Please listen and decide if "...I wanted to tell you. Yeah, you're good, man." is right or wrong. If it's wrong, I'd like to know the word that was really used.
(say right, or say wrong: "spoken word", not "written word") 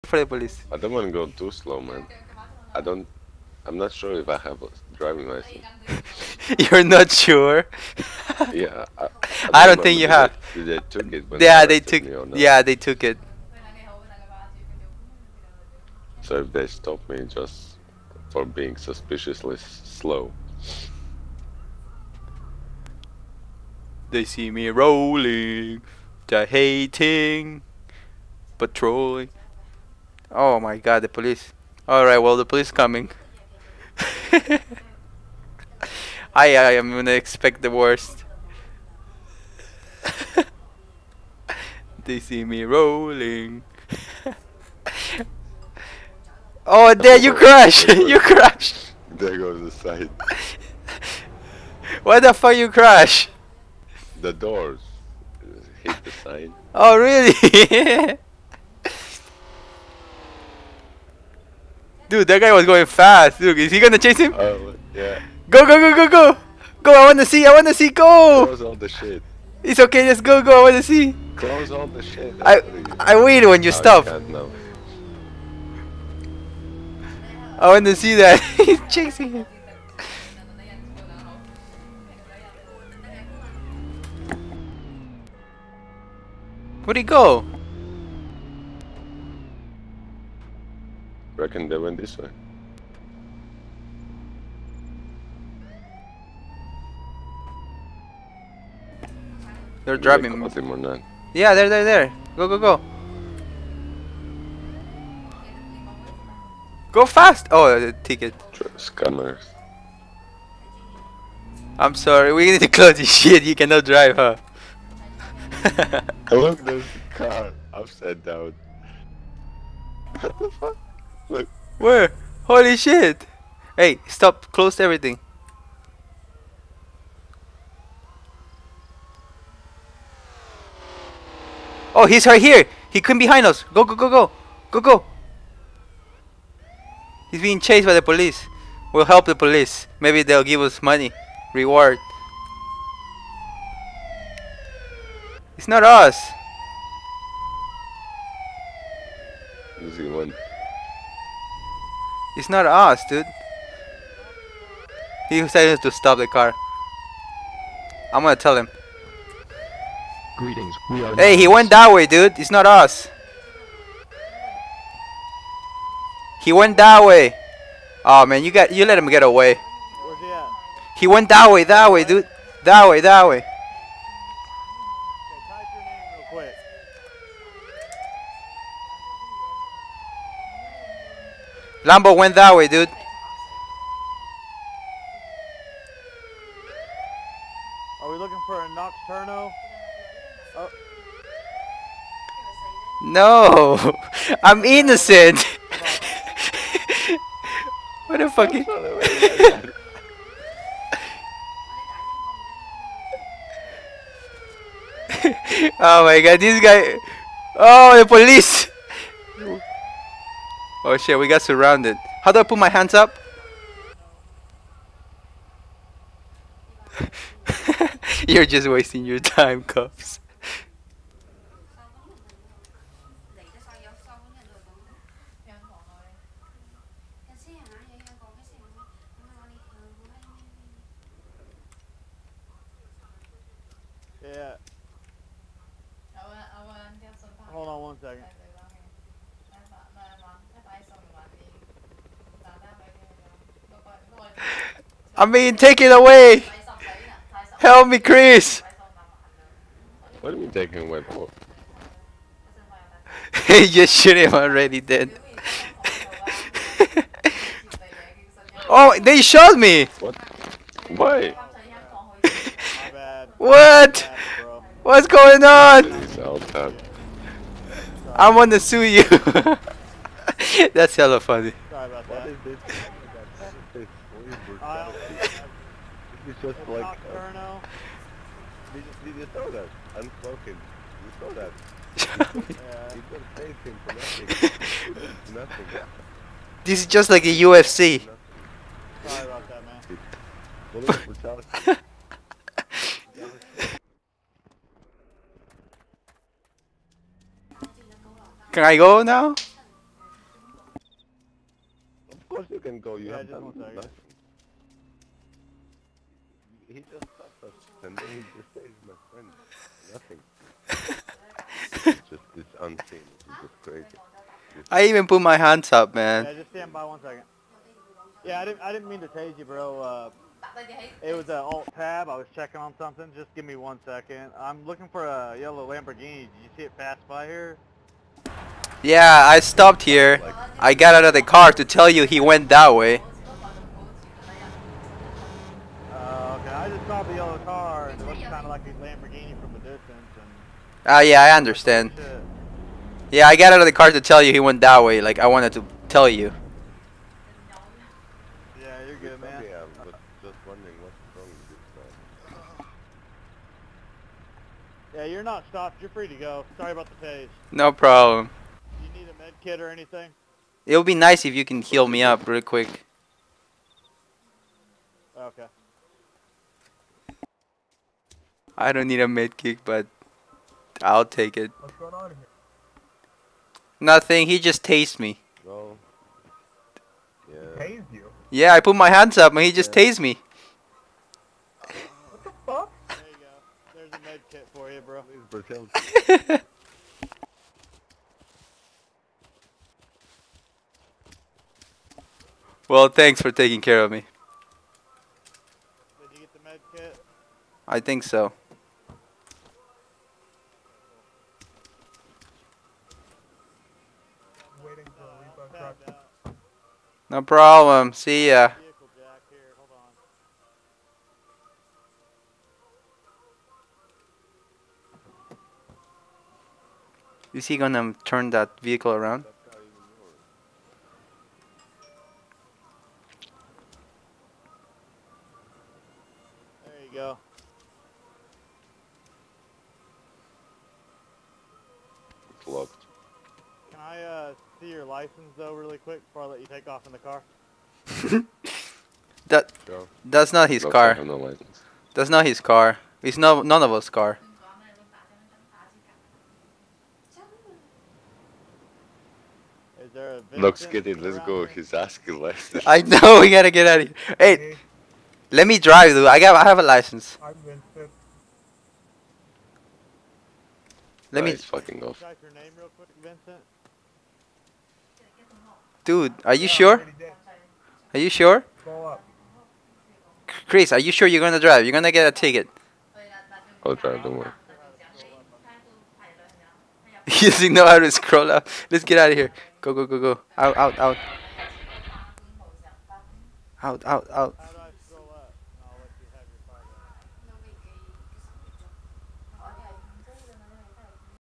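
right.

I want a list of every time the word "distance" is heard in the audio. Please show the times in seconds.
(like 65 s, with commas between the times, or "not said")
339 s.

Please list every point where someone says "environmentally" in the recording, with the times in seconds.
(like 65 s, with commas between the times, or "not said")
not said.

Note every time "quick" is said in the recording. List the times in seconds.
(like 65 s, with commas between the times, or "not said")
362 s, 435 s, 462 s.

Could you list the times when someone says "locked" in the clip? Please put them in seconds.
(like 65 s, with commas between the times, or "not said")
432 s.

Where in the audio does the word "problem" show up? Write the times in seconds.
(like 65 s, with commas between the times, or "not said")
357 s, 407 s.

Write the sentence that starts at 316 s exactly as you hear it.
Yeah, just stand by one second.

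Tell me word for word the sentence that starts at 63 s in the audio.
Dude, is he gonna chase him?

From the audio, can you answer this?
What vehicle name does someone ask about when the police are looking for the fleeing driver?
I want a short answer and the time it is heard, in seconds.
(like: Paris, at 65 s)
Noxturno, at 188 s.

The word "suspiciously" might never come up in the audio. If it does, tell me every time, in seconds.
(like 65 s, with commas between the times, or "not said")
18 s.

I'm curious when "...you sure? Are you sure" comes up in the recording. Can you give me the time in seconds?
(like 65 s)
466 s.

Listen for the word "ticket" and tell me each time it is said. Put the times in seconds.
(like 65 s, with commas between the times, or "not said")
108 s, 472 s.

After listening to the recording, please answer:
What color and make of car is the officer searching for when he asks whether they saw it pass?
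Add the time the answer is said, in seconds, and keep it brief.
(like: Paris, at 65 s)
Yellow Lamborghini, at 325 s.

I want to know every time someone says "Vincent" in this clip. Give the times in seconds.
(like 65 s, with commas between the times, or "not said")
457 s, 463 s.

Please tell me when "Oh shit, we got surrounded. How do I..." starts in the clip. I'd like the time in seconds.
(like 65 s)
210 s.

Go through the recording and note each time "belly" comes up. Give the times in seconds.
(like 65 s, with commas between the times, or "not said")
not said.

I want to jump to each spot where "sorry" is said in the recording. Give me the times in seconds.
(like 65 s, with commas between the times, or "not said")
111 s, 289 s, 356 s.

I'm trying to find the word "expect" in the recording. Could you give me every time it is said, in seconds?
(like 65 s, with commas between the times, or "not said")
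37 s.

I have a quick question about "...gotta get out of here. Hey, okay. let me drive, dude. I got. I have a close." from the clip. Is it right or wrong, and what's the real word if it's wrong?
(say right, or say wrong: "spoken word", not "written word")
wrong: "license", not "close".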